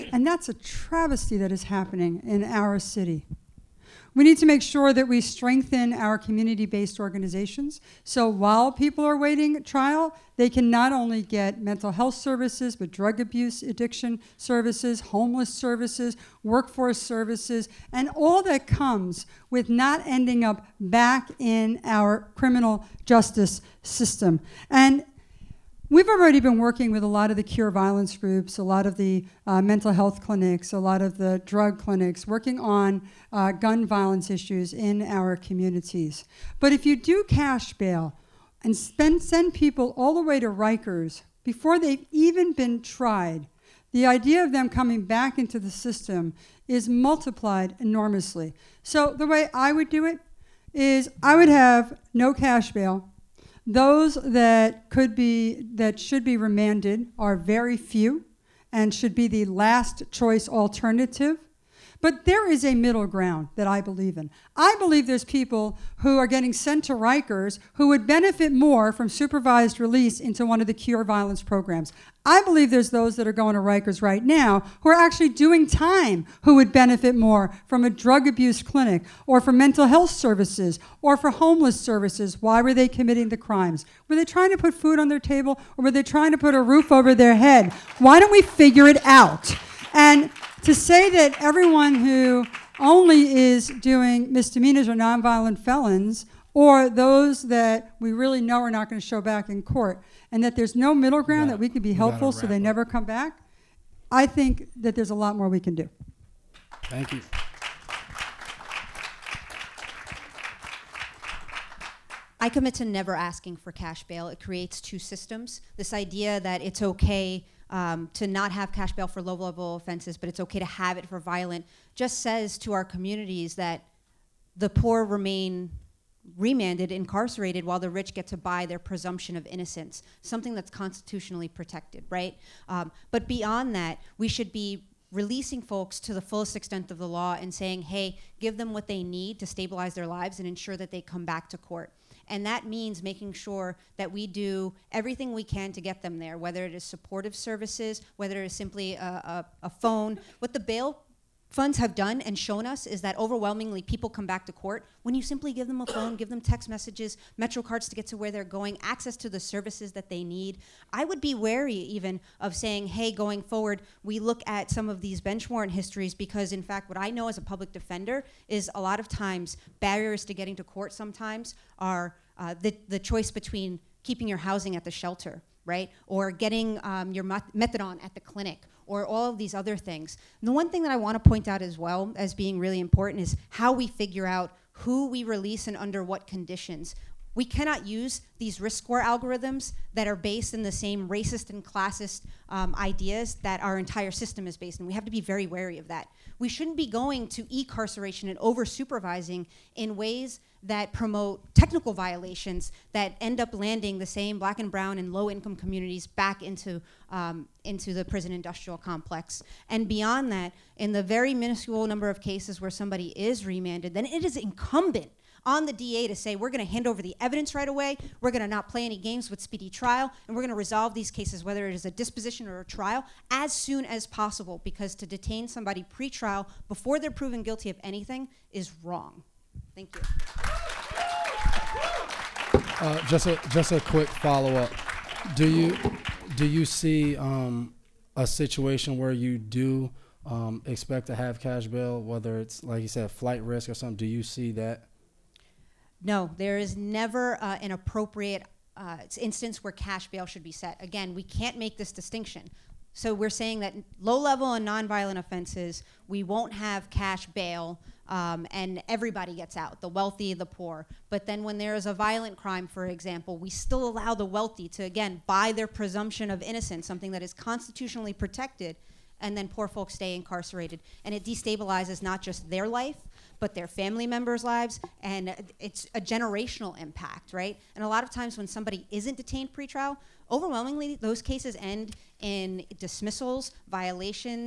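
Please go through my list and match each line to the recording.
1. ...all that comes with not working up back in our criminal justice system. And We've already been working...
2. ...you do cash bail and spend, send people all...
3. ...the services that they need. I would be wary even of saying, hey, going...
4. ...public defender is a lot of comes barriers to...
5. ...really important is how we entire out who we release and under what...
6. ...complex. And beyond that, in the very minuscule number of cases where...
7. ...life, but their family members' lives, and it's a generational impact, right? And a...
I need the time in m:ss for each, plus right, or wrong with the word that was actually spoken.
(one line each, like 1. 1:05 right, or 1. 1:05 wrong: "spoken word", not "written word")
1. 0:18 wrong: "ending", not "working"
2. 0:36 right
3. 2:39 right
4. 2:47 wrong: "times", not "comes"
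5. 3:02 wrong: "figure", not "entire"
6. 3:28 right
7. 4:32 right.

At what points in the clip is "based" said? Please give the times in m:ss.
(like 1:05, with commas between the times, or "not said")
0:06, 3:10, 3:14.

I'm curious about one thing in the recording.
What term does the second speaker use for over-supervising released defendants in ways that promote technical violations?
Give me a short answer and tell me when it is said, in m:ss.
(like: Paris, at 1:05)
E-carceration, at 3:17.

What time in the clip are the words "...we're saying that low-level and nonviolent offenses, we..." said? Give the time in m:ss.
4:13.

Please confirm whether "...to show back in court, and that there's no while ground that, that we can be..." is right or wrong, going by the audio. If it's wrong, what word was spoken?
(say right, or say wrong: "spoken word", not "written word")
wrong: "middle", not "while".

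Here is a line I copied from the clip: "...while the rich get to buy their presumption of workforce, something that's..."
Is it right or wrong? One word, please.
wrong.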